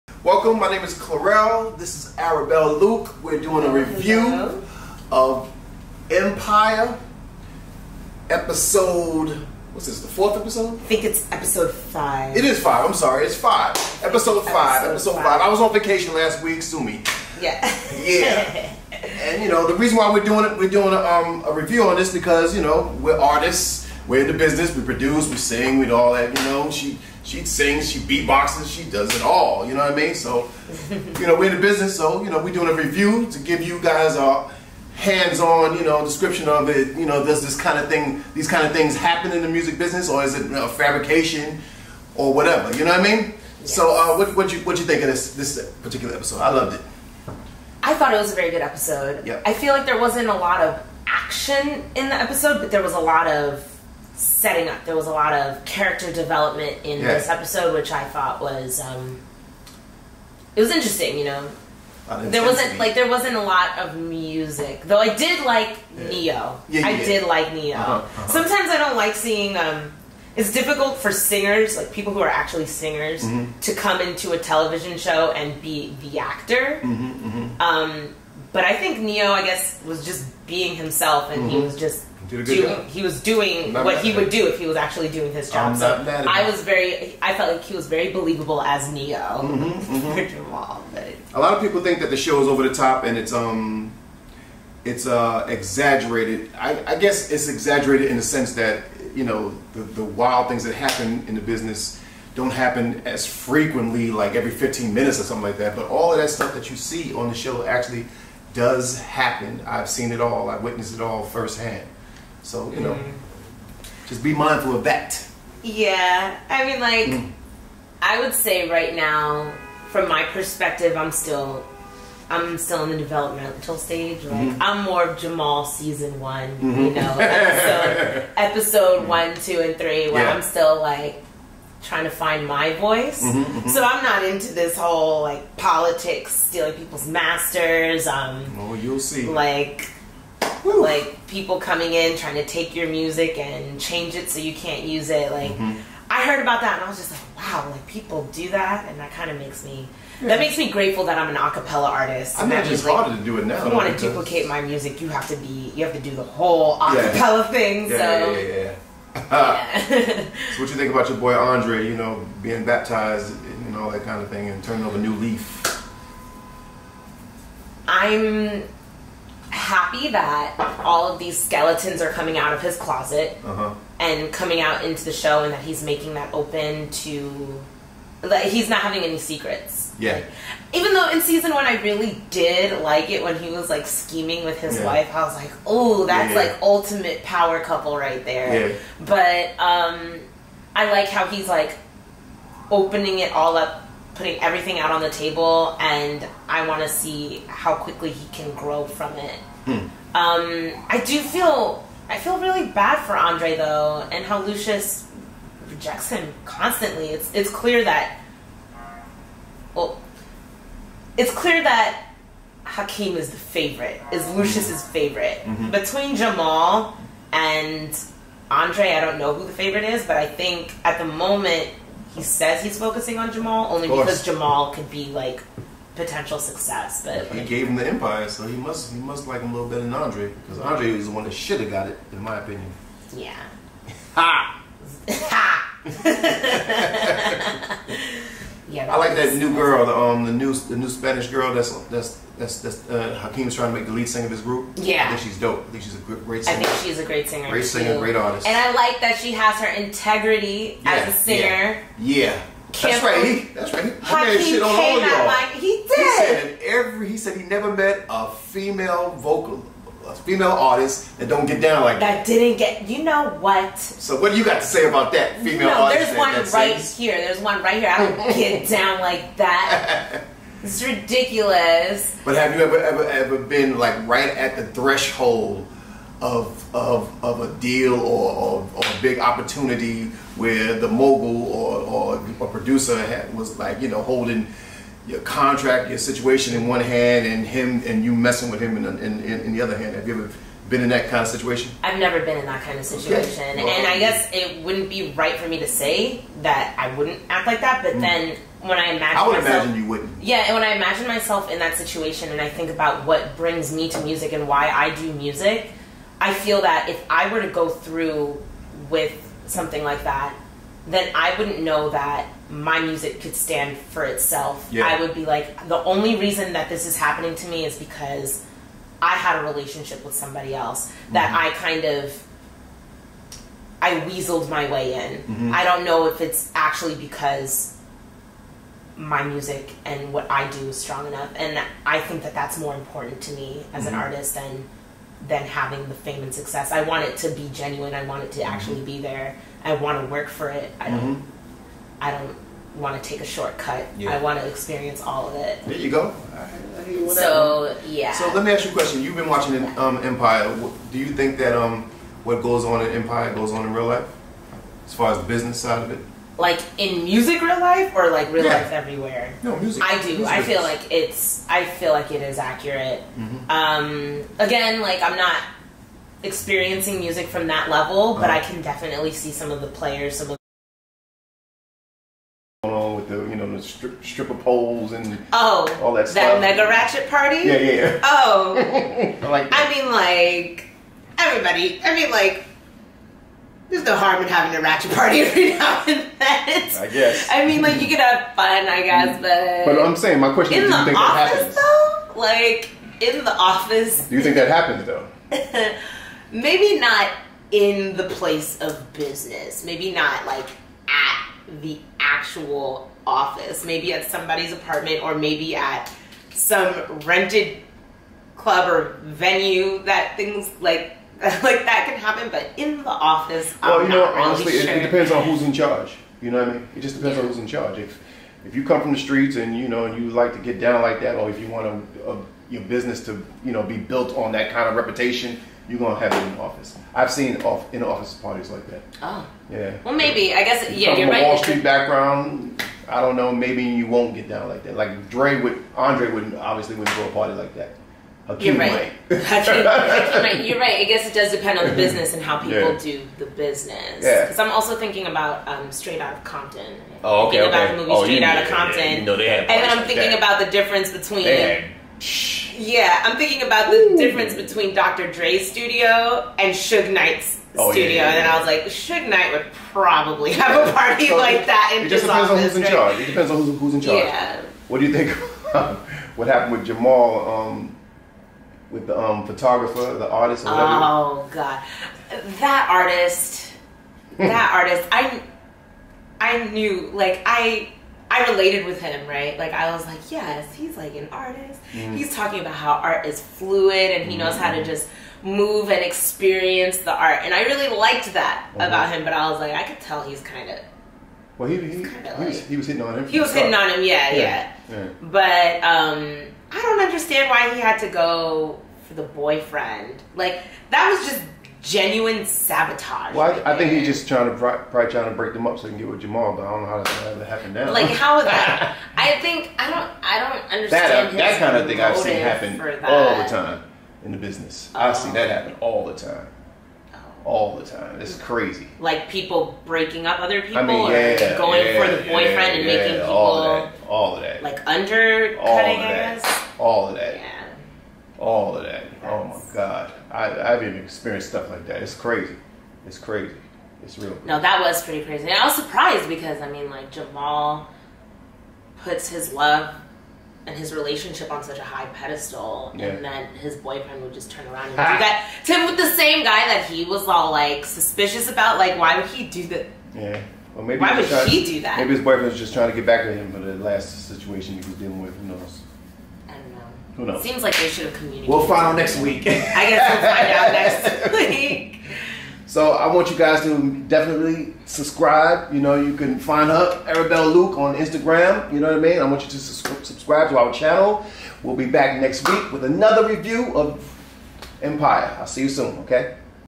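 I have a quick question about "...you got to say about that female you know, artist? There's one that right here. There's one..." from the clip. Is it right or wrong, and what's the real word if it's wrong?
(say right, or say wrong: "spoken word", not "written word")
right.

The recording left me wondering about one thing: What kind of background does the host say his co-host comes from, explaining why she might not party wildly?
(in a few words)
Wall Street.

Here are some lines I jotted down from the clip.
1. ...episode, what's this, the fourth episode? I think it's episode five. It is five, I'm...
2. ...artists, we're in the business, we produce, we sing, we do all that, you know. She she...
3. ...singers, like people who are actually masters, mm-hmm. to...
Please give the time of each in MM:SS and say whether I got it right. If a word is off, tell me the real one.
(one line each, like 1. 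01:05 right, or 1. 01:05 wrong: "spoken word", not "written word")
1. 00:08 right
2. 00:23 right
3. 01:11 wrong: "singers", not "masters".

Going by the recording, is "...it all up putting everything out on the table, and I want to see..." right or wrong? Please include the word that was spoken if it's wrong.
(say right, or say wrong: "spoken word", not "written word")
right.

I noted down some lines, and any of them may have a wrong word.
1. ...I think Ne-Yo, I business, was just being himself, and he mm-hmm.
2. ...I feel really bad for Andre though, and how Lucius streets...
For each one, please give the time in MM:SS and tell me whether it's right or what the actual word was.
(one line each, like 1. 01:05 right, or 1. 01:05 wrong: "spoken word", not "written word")
1. 01:18 wrong: "guess", not "business"
2. 03:22 wrong: "rejects", not "streets".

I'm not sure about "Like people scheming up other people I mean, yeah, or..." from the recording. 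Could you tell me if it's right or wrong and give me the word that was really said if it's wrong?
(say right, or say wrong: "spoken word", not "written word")
wrong: "breaking", not "scheming".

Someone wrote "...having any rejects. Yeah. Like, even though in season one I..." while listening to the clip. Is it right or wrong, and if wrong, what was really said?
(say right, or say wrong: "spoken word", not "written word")
wrong: "secrets", not "rejects".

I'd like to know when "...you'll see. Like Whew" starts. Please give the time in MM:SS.
02:18.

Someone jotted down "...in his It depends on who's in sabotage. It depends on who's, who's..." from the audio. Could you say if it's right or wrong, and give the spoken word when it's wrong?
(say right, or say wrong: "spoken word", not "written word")
wrong: "charge", not "sabotage".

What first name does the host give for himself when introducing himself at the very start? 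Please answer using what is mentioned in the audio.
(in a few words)
Clurel.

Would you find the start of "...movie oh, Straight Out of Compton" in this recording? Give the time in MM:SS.
07:27.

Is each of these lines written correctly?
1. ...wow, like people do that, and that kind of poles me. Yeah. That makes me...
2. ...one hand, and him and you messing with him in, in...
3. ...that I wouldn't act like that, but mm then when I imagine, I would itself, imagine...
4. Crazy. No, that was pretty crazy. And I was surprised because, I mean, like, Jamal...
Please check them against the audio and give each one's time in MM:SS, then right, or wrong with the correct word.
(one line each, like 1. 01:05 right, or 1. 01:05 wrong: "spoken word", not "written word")
1. 02:27 wrong: "makes", not "poles"
2. 04:46 right
3. 04:56 wrong: "myself", not "itself"
4. 08:54 right.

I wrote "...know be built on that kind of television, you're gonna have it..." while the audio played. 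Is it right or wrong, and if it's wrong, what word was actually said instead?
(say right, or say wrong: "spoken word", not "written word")
wrong: "reputation", not "television".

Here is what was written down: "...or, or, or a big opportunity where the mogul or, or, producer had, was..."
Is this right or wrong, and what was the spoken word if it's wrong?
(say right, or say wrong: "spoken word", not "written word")
right.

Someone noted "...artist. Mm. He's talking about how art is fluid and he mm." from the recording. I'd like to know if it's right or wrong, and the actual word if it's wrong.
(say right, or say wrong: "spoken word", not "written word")
right.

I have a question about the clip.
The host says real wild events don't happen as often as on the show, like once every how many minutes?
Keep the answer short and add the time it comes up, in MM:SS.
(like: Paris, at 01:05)
15, at 01:44.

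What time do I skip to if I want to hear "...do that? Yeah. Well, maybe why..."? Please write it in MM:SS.
09:09.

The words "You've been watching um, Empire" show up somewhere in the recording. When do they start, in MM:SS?
05:49.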